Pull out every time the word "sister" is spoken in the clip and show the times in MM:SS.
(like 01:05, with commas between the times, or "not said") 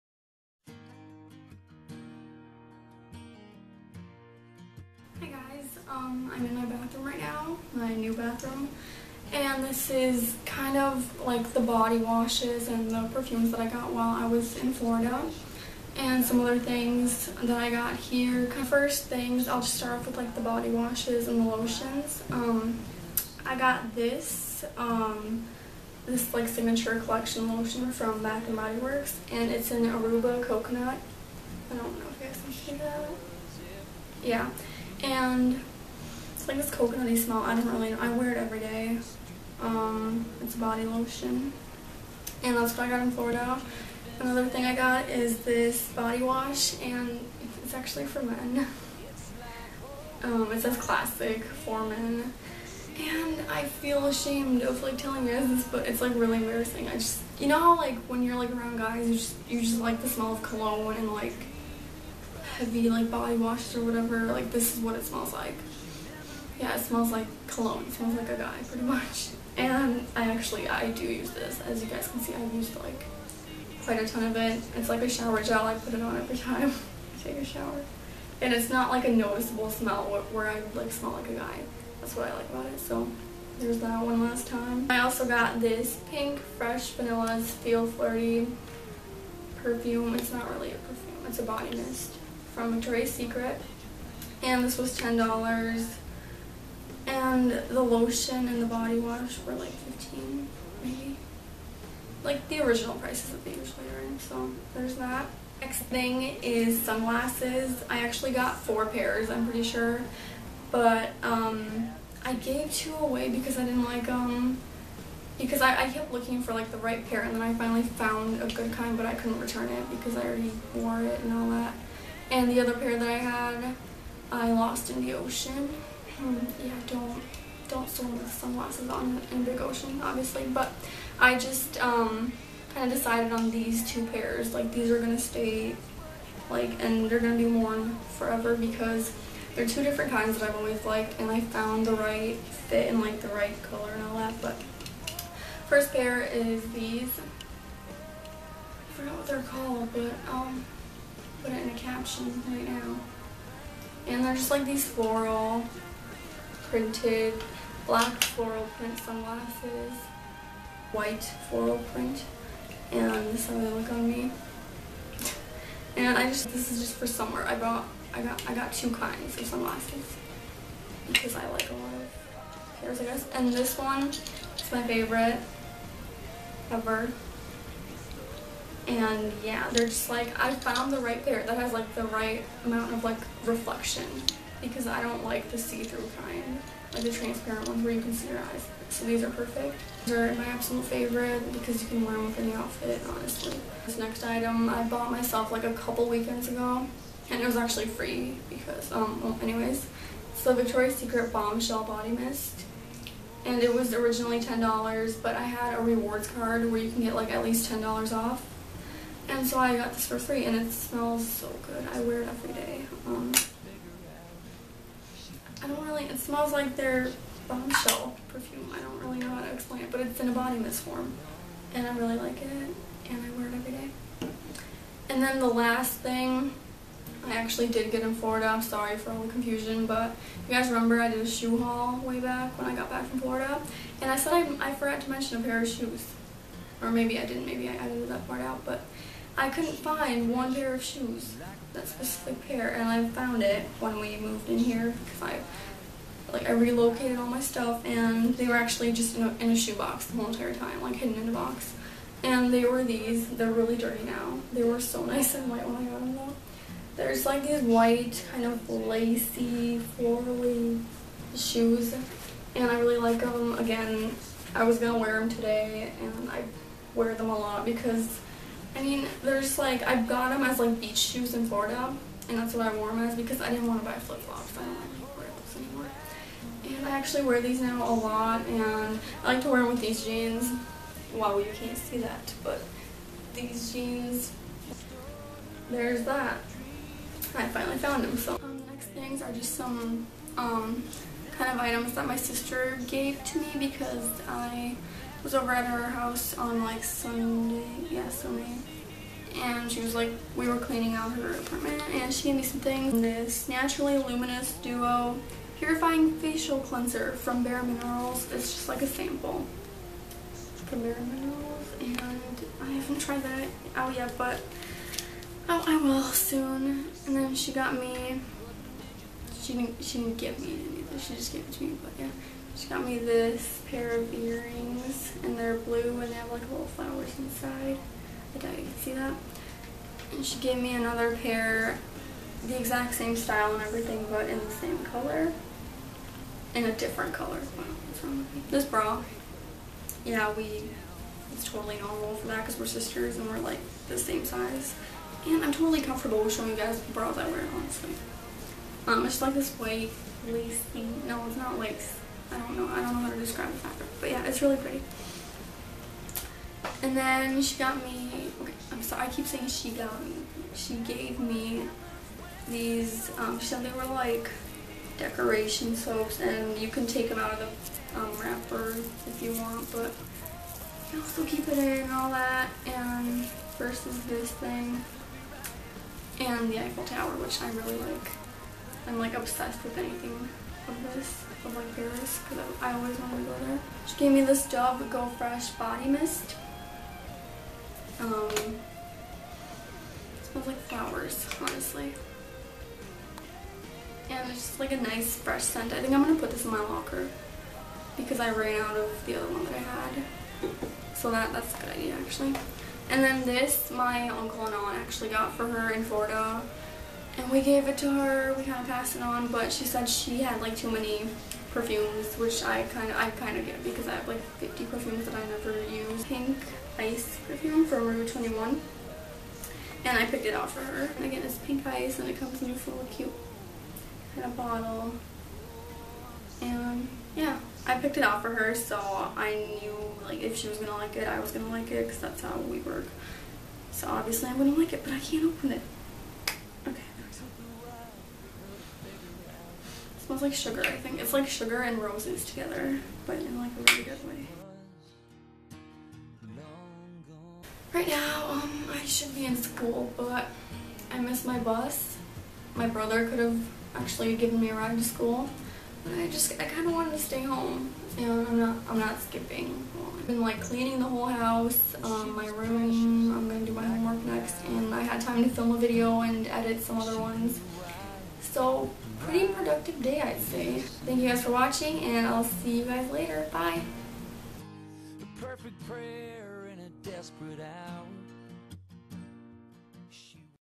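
04:52, 05:42.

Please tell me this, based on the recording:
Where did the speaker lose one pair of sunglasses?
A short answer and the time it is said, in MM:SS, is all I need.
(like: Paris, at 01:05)
In the ocean, at 02:04.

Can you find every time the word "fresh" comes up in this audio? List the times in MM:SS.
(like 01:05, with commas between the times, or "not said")
01:26, 06:25, 06:35.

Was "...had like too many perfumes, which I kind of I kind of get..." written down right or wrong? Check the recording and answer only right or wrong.
right.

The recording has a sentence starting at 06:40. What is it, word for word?
So that, that's a good idea, actually.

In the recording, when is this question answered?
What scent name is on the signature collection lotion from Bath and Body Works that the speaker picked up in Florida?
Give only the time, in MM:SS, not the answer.
00:29.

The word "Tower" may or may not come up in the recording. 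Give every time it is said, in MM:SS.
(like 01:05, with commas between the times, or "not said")
06:16.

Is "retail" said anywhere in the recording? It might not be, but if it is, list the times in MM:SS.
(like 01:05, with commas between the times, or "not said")
not said.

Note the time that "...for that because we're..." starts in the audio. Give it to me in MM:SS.
05:42.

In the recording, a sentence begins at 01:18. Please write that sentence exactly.
And it's not like a noticeable smell where I like smell like a guy.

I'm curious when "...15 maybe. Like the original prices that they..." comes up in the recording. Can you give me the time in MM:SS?
01:39.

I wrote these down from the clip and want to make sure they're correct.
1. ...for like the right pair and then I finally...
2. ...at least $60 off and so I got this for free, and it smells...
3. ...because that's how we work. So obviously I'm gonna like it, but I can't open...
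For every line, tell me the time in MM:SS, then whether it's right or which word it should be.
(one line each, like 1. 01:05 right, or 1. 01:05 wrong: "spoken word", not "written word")
1. 01:56 right
2. 03:27 wrong: "10", not "60"
3. 07:11 right.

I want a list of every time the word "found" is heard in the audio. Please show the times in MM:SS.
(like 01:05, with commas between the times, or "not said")
01:57, 02:21, 03:00, 04:03, 04:47.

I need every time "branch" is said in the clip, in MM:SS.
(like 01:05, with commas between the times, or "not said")
not said.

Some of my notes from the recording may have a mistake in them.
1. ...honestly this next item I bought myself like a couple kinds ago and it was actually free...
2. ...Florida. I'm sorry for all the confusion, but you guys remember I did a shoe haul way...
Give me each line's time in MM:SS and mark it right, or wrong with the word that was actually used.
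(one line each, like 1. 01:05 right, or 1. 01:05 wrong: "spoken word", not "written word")
1. 03:13 wrong: "weekends", not "kinds"
2. 03:48 right.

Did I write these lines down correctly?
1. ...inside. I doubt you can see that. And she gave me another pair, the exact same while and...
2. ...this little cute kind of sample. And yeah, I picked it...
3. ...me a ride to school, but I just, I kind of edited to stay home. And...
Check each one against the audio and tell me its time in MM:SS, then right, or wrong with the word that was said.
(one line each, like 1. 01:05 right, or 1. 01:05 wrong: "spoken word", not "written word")
1. 05:27 wrong: "style", not "while"
2. 07:02 wrong: "bottle", not "sample"
3. 07:34 wrong: "wanted", not "edited".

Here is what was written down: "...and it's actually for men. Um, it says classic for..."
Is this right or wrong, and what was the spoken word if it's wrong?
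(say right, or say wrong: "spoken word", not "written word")
right.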